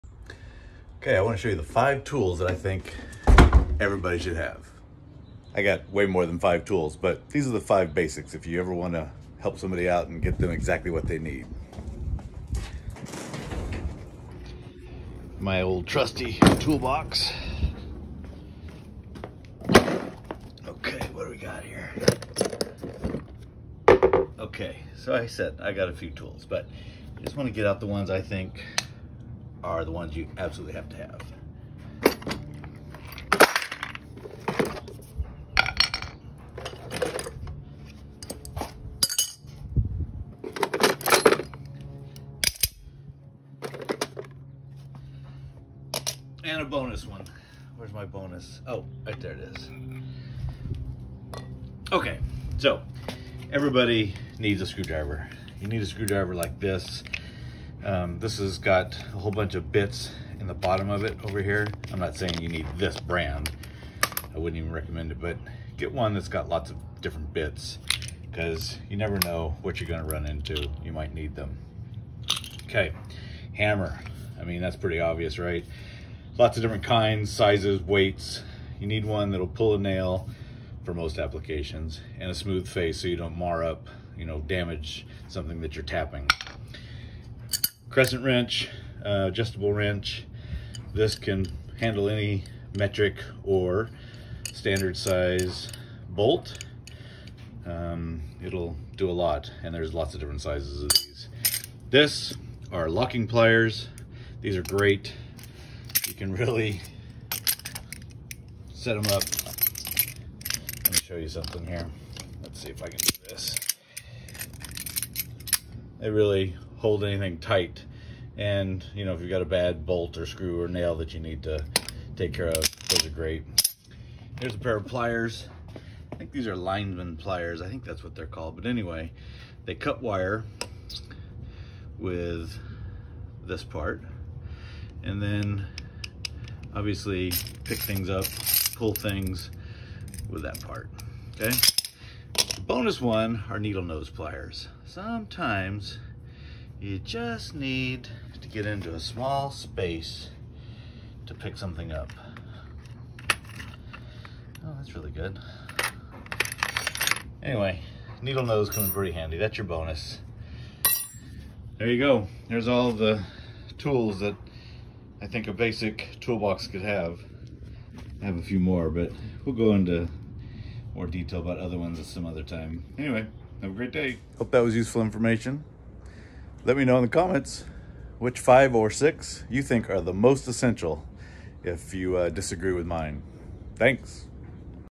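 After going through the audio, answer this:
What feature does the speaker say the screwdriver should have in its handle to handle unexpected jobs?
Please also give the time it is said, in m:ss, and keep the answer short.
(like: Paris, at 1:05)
lots of different bits, at 1:06.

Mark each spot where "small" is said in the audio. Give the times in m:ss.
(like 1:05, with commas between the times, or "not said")
2:28.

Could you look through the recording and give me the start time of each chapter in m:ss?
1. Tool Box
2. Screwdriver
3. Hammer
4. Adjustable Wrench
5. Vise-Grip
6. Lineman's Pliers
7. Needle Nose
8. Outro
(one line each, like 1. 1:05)
1. 0:27
2. 0:54
3. 1:13
4. 1:27
5. 1:42
6. 2:05
7. 2:23
8. 2:41.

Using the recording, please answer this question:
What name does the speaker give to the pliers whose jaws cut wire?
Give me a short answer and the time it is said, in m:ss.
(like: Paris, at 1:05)
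lineman pliers, at 2:06.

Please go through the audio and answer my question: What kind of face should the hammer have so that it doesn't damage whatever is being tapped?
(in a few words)
smooth face.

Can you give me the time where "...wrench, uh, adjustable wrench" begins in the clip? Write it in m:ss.
1:28.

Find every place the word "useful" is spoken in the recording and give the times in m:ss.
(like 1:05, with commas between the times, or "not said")
2:54.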